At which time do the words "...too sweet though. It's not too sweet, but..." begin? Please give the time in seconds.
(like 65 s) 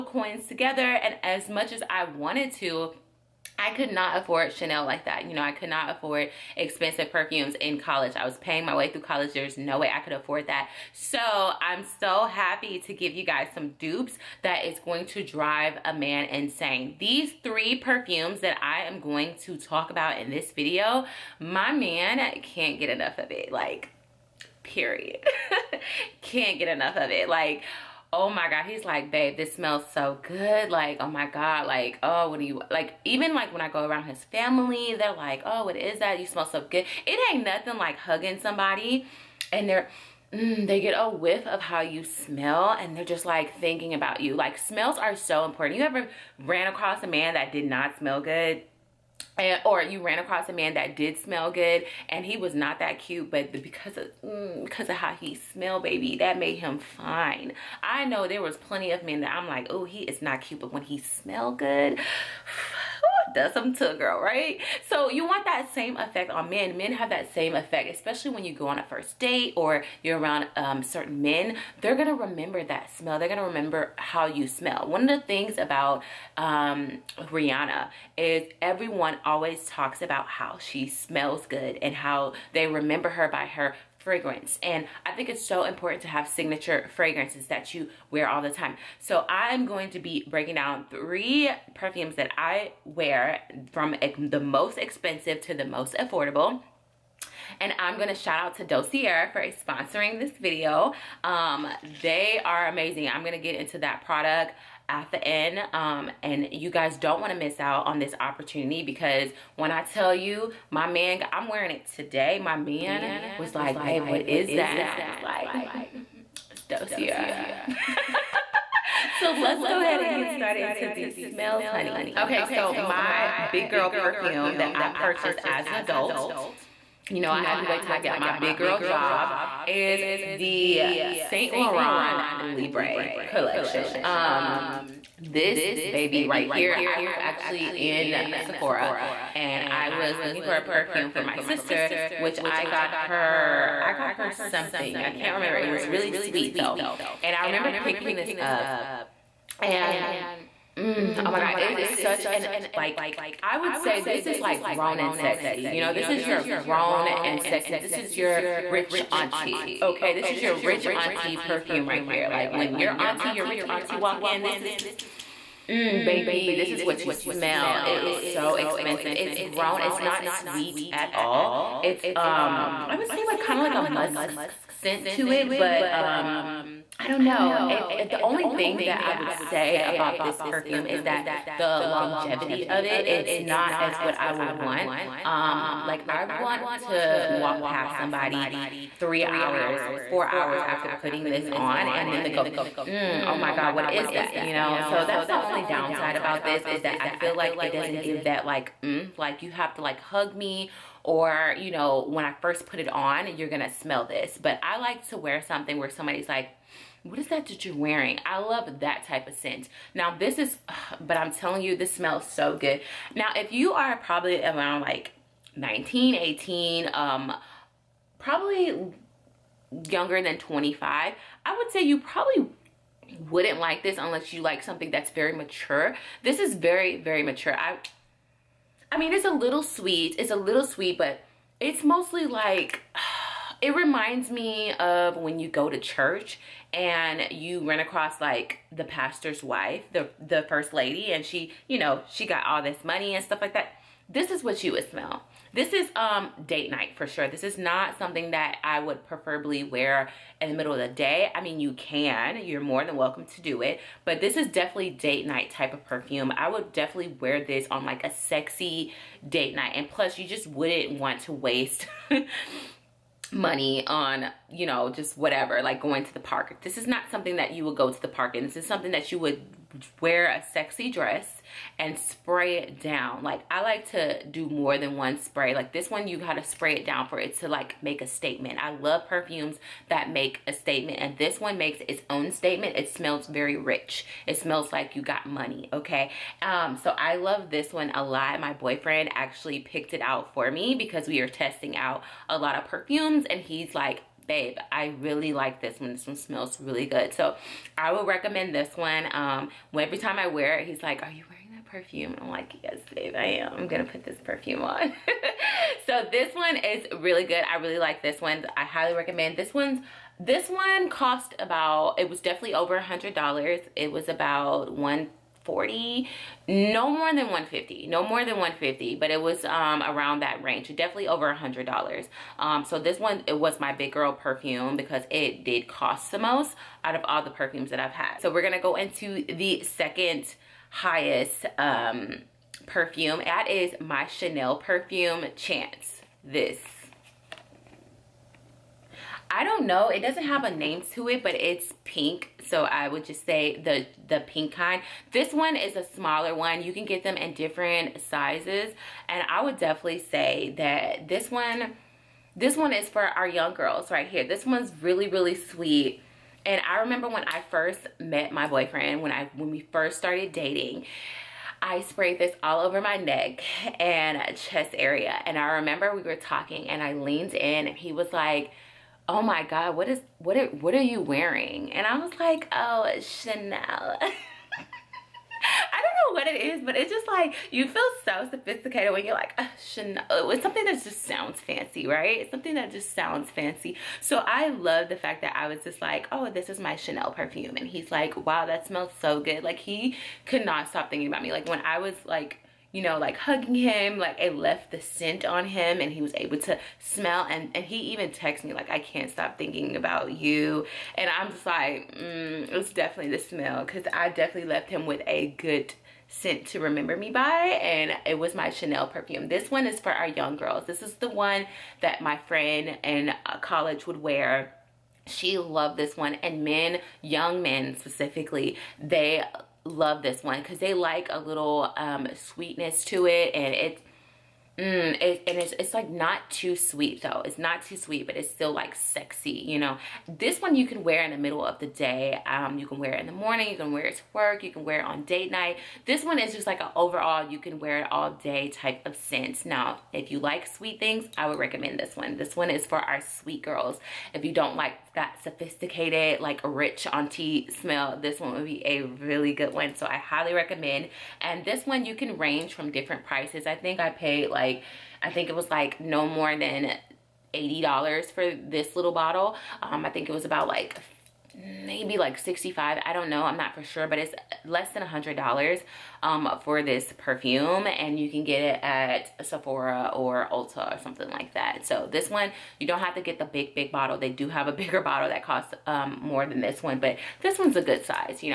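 426 s.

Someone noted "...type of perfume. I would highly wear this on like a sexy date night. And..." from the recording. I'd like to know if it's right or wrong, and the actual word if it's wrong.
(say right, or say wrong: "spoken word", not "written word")
wrong: "definitely", not "highly".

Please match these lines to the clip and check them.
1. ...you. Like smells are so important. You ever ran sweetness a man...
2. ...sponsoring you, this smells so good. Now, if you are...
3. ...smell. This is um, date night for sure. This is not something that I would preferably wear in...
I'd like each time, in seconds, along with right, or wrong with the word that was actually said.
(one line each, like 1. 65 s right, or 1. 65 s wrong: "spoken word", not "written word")
1. 44 s wrong: "across", not "sweetness"
2. 211 s wrong: "telling", not "sponsoring"
3. 244 s right.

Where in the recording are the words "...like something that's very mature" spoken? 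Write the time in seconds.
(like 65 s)
224 s.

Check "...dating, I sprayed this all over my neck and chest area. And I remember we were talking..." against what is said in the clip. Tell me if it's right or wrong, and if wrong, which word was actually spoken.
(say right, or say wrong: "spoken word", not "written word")
right.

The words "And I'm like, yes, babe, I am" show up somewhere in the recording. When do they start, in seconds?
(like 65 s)
302 s.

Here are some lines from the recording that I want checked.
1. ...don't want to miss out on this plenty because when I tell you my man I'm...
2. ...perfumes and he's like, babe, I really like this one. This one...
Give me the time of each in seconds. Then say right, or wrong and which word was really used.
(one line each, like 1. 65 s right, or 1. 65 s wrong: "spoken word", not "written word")
1. 106 s wrong: "opportunity", not "plenty"
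2. 292 s right.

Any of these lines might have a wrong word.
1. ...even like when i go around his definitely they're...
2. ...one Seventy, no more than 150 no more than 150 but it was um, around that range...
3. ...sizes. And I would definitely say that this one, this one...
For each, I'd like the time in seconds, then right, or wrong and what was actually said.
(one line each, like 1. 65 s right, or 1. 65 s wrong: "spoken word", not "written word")
1. 33 s wrong: "family", not "definitely"
2. 314 s wrong: "Forty", not "Seventy"
3. 348 s right.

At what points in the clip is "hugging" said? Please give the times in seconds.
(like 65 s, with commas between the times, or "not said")
37 s, 393 s.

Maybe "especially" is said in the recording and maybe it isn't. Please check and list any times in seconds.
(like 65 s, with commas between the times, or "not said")
67 s.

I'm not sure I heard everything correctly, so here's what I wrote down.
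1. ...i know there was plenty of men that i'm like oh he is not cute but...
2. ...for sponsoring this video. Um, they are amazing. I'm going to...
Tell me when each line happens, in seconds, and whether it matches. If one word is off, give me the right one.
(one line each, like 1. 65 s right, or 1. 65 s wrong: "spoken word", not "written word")
1. 57 s right
2. 99 s right.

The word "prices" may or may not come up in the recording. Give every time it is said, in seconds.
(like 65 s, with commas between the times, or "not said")
453 s.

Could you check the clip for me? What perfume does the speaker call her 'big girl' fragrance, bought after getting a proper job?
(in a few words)
Saint Laurent Libre.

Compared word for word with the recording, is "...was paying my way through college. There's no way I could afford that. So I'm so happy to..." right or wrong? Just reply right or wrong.
right.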